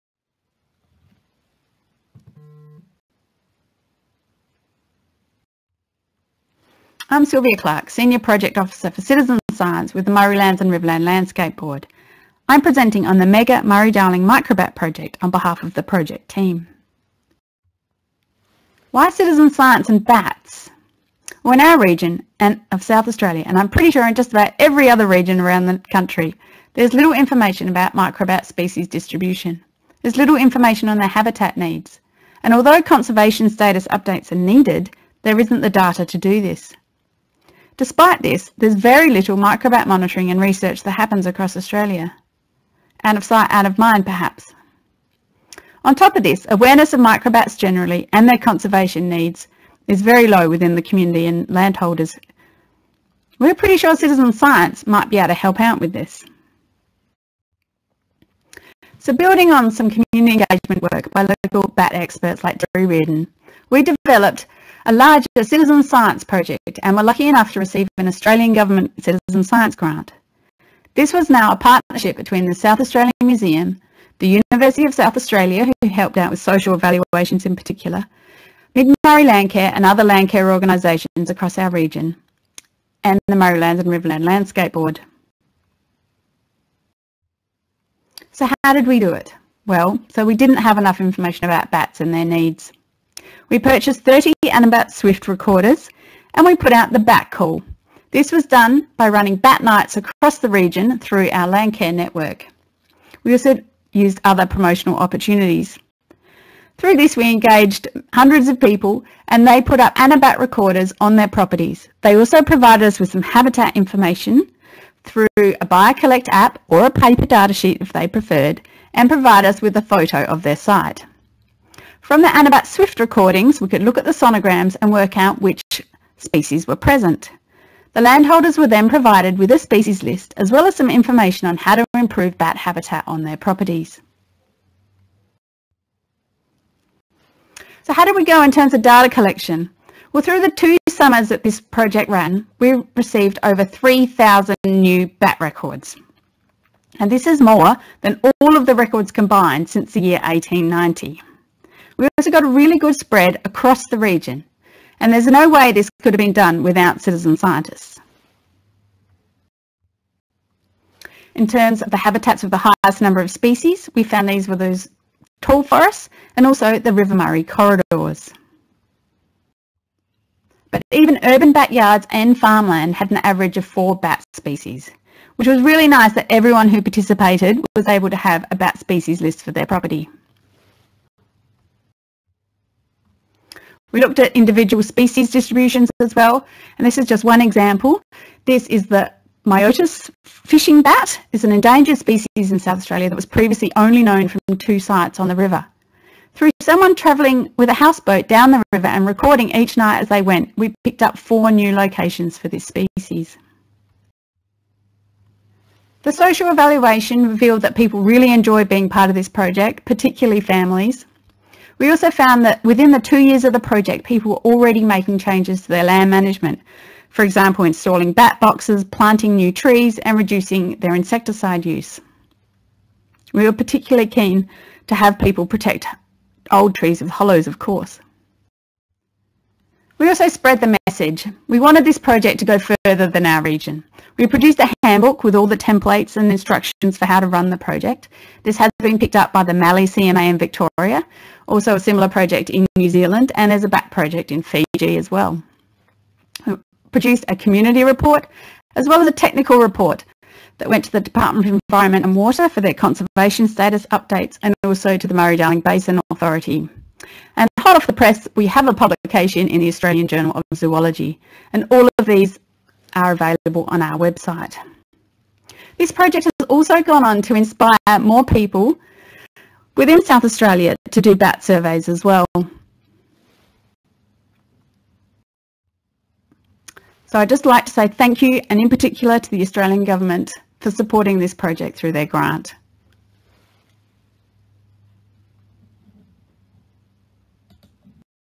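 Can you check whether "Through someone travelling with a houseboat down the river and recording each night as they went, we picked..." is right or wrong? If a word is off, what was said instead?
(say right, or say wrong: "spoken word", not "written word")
right.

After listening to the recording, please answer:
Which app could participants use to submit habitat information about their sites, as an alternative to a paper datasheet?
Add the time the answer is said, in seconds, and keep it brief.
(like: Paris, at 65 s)
BioCollect, at 115 s.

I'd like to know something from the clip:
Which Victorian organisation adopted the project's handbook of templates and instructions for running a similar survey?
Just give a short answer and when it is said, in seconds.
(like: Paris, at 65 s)
Mallee CMA, at 239 s.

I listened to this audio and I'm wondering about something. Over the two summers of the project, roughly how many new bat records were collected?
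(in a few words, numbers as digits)
over 3,000.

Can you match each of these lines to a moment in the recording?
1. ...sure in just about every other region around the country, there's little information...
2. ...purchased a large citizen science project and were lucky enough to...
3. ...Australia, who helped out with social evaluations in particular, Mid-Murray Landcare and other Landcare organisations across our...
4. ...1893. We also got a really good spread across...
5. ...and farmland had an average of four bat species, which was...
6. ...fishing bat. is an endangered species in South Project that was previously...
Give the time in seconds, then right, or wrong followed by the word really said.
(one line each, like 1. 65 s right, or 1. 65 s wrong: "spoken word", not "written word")
1. 23 s right
2. 63 s wrong: "developed", not "purchased"
3. 75 s right
4. 150 s wrong: "1890", not "1893"
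5. 172 s right
6. 190 s wrong: "Australia", not "Project".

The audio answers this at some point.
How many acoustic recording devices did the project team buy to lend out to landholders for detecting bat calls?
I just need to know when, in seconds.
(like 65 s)
94 s.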